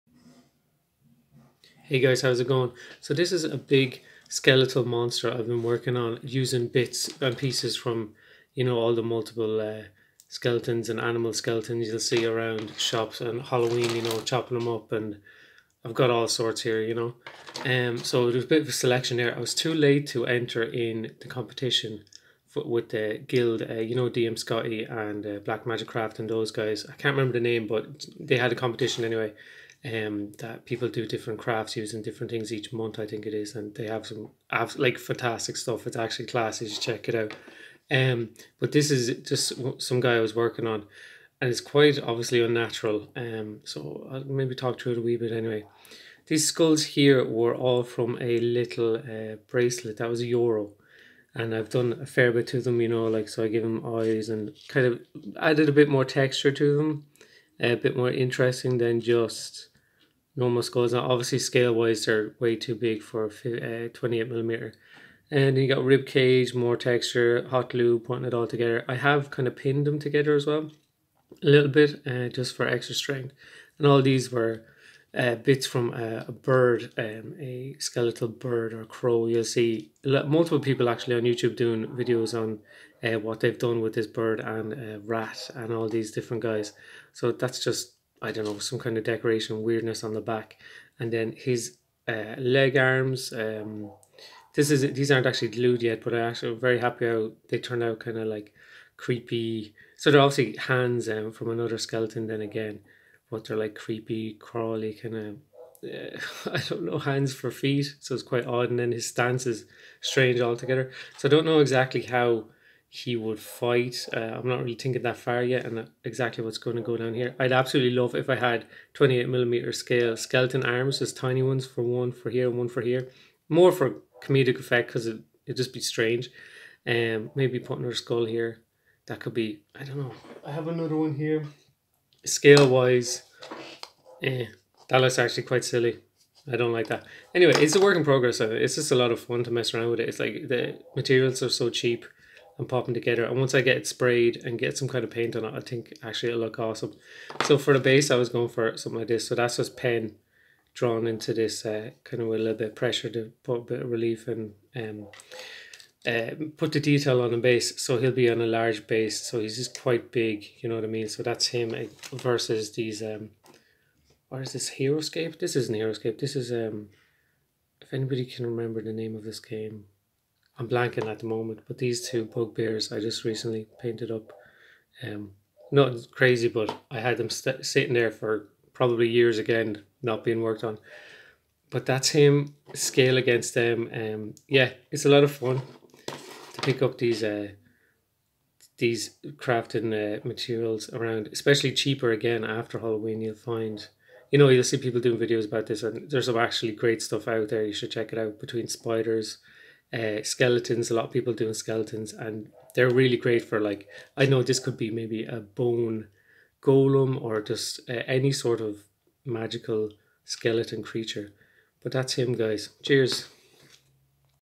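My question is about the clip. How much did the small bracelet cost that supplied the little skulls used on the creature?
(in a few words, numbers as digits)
a euro.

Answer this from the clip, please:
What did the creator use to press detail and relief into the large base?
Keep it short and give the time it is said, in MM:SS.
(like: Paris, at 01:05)
pen, at 02:29.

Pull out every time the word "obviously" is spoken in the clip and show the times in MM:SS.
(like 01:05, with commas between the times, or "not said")
00:41, 01:01, 01:40.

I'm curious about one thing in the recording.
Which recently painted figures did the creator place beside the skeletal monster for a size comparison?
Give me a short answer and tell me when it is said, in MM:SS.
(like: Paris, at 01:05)
two bugbears, at 02:52.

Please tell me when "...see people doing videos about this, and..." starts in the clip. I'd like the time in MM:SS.
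03:14.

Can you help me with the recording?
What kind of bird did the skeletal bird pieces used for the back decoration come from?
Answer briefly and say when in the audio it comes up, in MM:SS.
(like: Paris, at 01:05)
crow, at 01:18.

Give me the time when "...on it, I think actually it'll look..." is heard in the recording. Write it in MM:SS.
02:25.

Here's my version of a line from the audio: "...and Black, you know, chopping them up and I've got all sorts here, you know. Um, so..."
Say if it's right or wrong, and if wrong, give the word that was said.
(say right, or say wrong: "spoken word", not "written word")
wrong: "Halloween", not "Black".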